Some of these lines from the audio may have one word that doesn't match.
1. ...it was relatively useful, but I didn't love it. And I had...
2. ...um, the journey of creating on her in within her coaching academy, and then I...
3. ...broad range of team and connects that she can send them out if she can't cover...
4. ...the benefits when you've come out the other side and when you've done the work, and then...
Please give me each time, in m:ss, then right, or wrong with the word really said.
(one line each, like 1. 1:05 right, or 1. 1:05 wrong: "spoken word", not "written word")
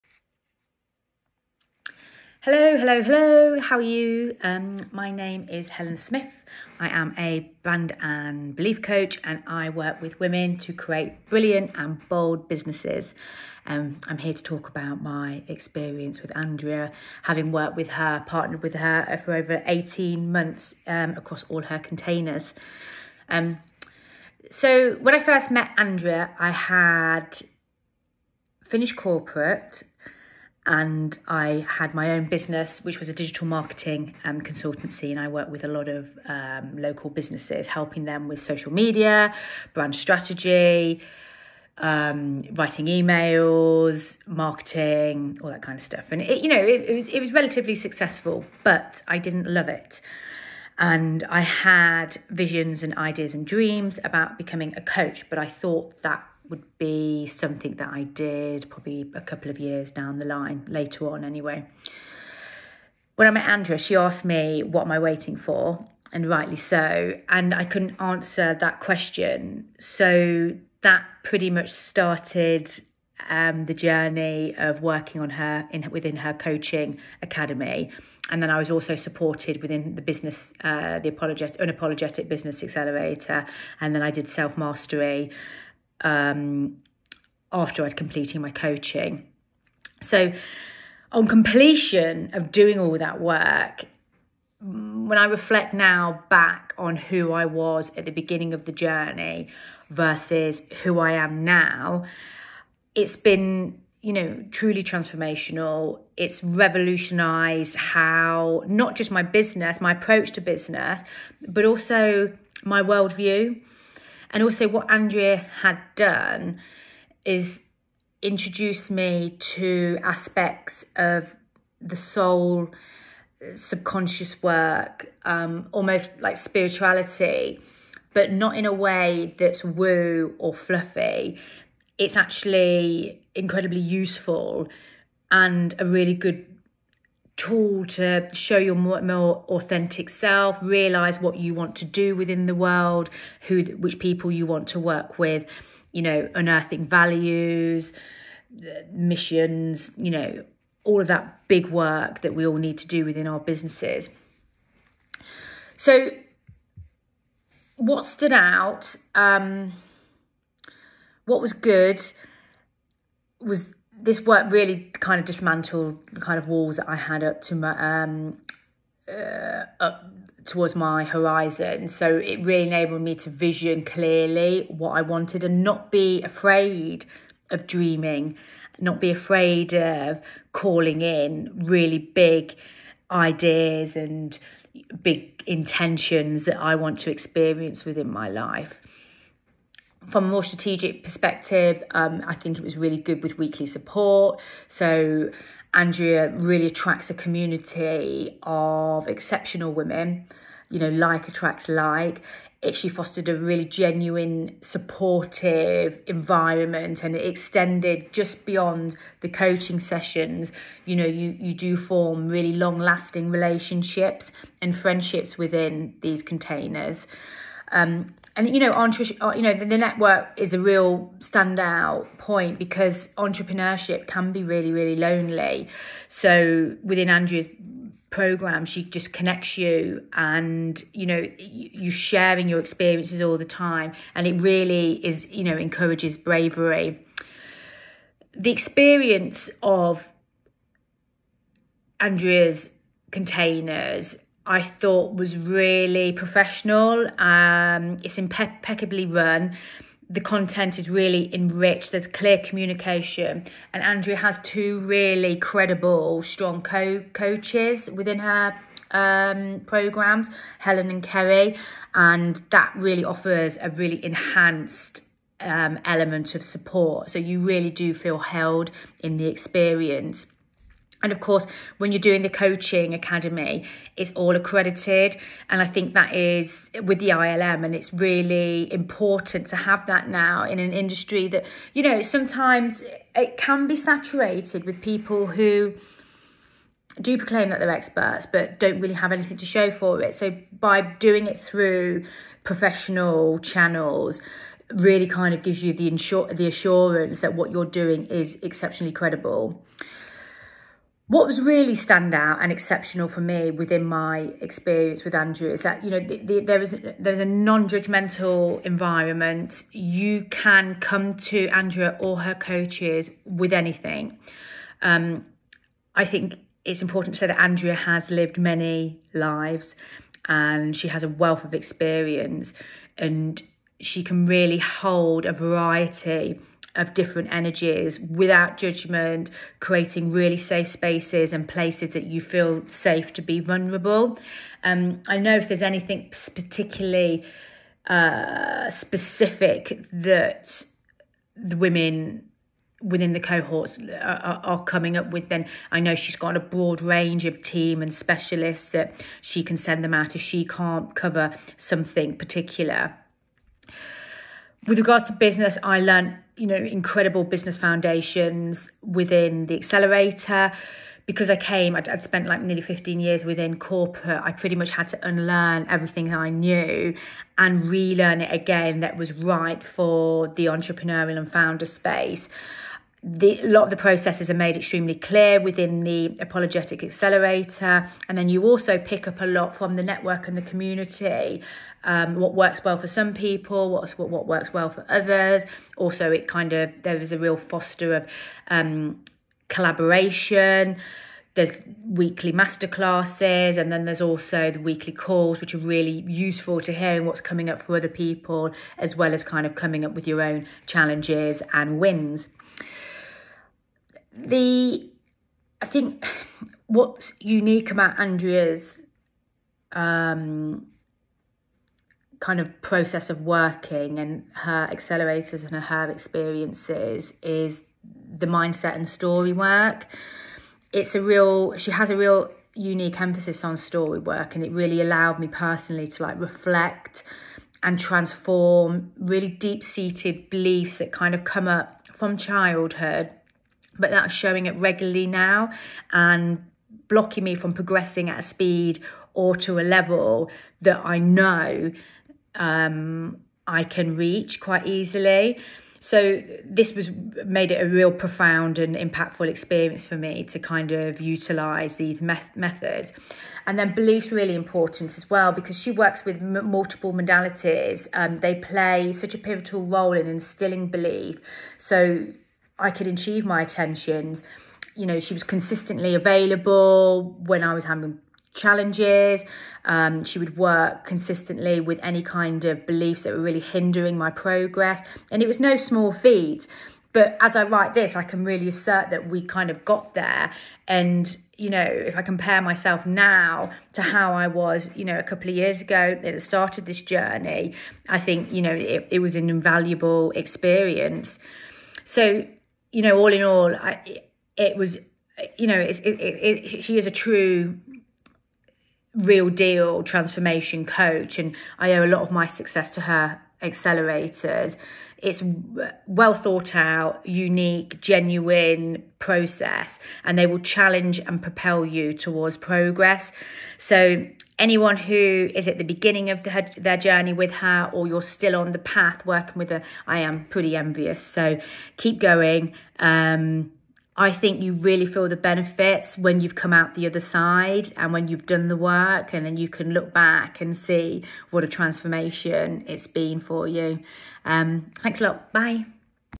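1. 0:47 wrong: "successful", not "useful"
2. 1:13 wrong: "working", not "creating"
3. 5:46 wrong: "specialists", not "connects"
4. 8:45 right.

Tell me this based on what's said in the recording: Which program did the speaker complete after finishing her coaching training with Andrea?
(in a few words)
Self mastery.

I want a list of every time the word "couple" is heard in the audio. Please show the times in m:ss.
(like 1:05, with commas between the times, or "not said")
0:59, 8:05.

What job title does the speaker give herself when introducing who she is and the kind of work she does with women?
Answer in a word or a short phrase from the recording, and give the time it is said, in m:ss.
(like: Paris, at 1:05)
Brand and belief coach, at 0:07.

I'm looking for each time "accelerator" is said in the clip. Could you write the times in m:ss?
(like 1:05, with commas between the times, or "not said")
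1:22, 5:59, 6:16, 6:54, 8:23.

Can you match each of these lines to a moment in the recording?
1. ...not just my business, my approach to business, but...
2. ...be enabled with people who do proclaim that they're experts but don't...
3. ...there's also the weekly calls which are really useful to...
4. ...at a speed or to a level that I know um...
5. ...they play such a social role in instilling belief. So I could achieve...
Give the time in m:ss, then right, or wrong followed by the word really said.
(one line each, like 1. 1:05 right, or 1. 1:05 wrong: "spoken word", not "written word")
1. 1:48 right
2. 4:43 wrong: "saturated", not "enabled"
3. 6:33 right
4. 7:18 right
5. 7:38 wrong: "pivotal", not "social".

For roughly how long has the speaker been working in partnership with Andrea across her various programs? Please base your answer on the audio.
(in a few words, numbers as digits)
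18 months.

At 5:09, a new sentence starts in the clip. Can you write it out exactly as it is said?
You can come to Andrea or her coaches with anything.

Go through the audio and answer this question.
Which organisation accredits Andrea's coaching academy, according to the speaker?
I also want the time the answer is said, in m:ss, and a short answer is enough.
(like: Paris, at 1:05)
ILM, at 4:37.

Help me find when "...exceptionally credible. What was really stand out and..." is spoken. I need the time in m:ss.
4:58.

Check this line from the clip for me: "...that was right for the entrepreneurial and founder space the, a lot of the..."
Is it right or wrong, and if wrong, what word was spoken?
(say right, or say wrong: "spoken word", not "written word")
right.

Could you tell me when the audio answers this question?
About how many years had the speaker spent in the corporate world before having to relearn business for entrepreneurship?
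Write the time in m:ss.
6:02.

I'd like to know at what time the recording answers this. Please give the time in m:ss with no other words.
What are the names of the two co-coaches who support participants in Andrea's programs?
4:20.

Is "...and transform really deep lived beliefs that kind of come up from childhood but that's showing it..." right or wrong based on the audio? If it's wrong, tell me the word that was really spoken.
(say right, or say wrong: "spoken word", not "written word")
wrong: "seated", not "lived".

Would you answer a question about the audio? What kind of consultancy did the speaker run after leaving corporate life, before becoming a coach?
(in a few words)
Digital marketing.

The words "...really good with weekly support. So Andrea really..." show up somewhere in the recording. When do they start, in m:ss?
3:12.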